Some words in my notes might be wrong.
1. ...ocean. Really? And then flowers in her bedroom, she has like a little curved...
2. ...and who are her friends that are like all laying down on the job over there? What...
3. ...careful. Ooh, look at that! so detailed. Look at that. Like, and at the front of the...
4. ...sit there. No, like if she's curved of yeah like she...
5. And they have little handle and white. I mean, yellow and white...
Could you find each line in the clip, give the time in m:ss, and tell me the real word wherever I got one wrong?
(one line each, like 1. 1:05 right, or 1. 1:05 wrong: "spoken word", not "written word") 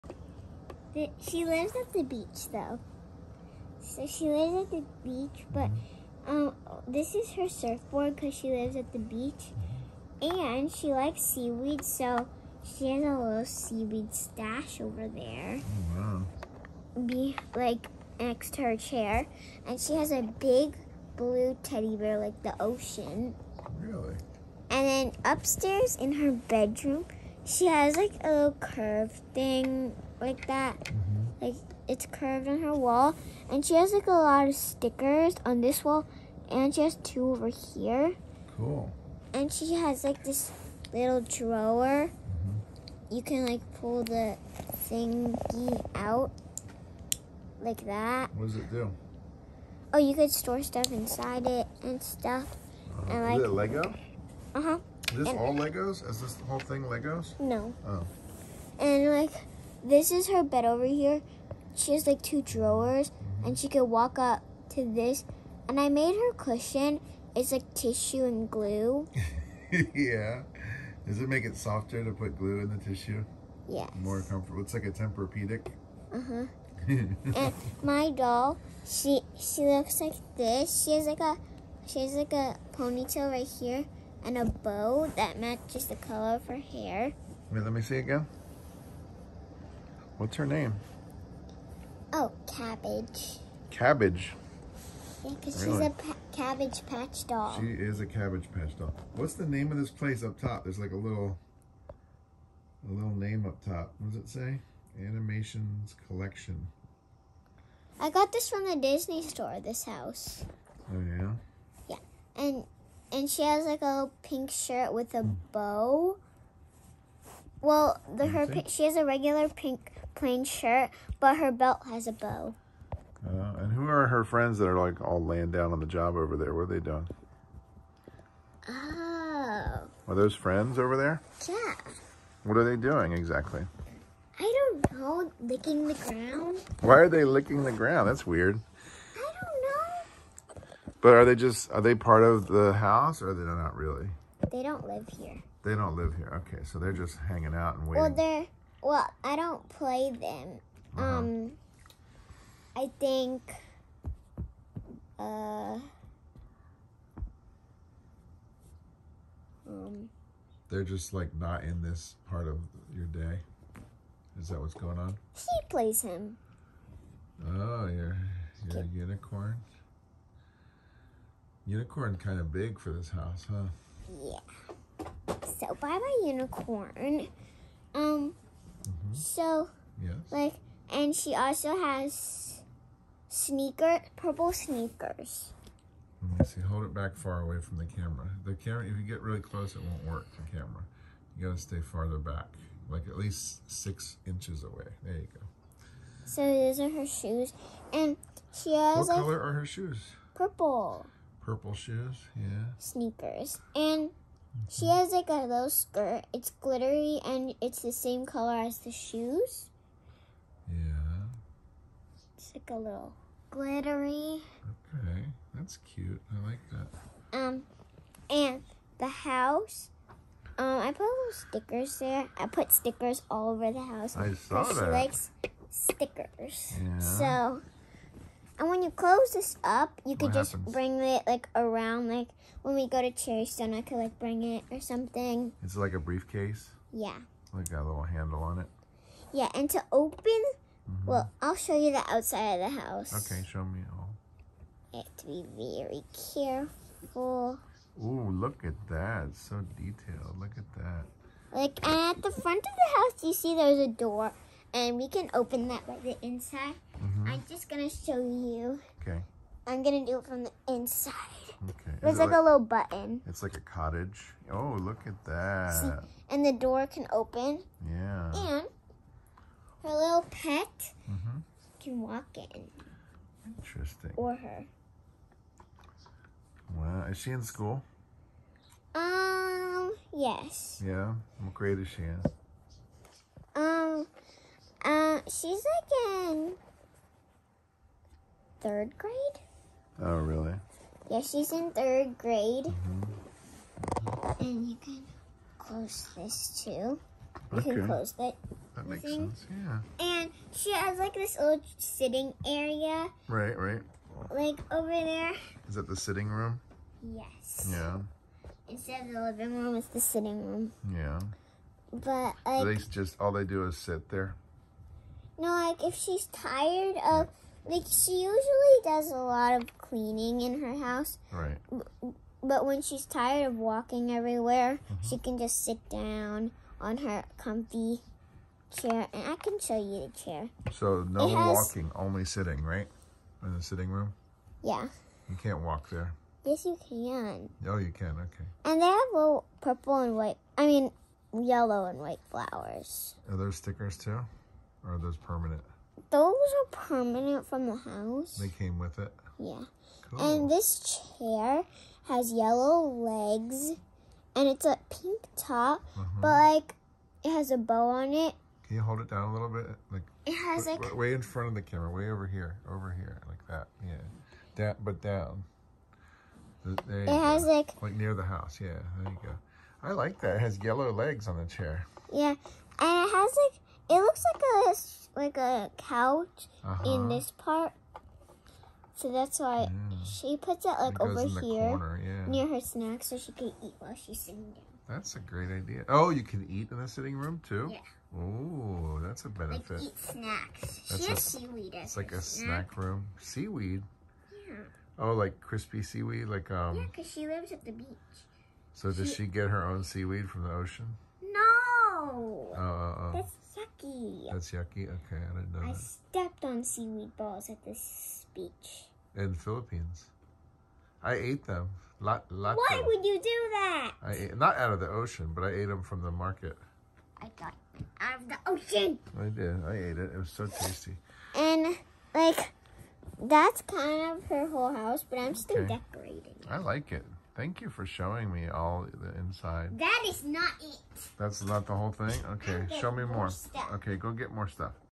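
1. 0:22 wrong: "upstairs", not "flowers"
2. 2:03 right
3. 4:06 right
4. 5:13 wrong: "tired", not "curved"
5. 5:38 wrong: "purple", not "handle".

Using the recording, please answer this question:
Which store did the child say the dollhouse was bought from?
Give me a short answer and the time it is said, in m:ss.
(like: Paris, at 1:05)
The Disney store, at 1:48.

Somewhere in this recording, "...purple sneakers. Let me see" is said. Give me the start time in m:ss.
3:04.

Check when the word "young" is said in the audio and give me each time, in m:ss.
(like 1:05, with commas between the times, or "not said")
not said.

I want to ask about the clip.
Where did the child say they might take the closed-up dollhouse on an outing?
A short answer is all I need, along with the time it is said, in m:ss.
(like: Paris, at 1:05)
Cherry Stone, at 3:53.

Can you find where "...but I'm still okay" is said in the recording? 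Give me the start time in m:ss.
7:05.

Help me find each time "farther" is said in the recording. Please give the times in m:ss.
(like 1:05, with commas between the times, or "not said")
3:11.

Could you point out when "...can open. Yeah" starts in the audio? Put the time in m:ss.
4:26.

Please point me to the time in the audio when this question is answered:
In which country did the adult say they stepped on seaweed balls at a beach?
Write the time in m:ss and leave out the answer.
6:49.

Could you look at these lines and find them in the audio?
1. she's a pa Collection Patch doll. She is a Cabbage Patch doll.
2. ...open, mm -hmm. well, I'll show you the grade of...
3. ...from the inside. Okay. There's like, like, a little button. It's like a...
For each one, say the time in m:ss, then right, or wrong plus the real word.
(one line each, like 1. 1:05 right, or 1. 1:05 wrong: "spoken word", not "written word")
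1. 1:35 wrong: "Cabbage", not "Collection"
2. 3:59 wrong: "outside", not "grade"
3. 4:20 right.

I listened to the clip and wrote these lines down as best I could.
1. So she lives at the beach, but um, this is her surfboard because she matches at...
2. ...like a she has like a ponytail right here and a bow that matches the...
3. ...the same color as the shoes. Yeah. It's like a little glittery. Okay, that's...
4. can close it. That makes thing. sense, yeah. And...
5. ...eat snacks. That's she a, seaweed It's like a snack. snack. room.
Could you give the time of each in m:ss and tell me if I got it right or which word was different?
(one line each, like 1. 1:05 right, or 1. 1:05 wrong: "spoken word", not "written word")
1. 0:03 wrong: "lives", not "matches"
2. 1:21 right
3. 3:27 right
4. 4:57 right
5. 6:29 right.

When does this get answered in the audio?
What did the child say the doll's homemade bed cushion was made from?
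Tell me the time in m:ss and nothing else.
1:07.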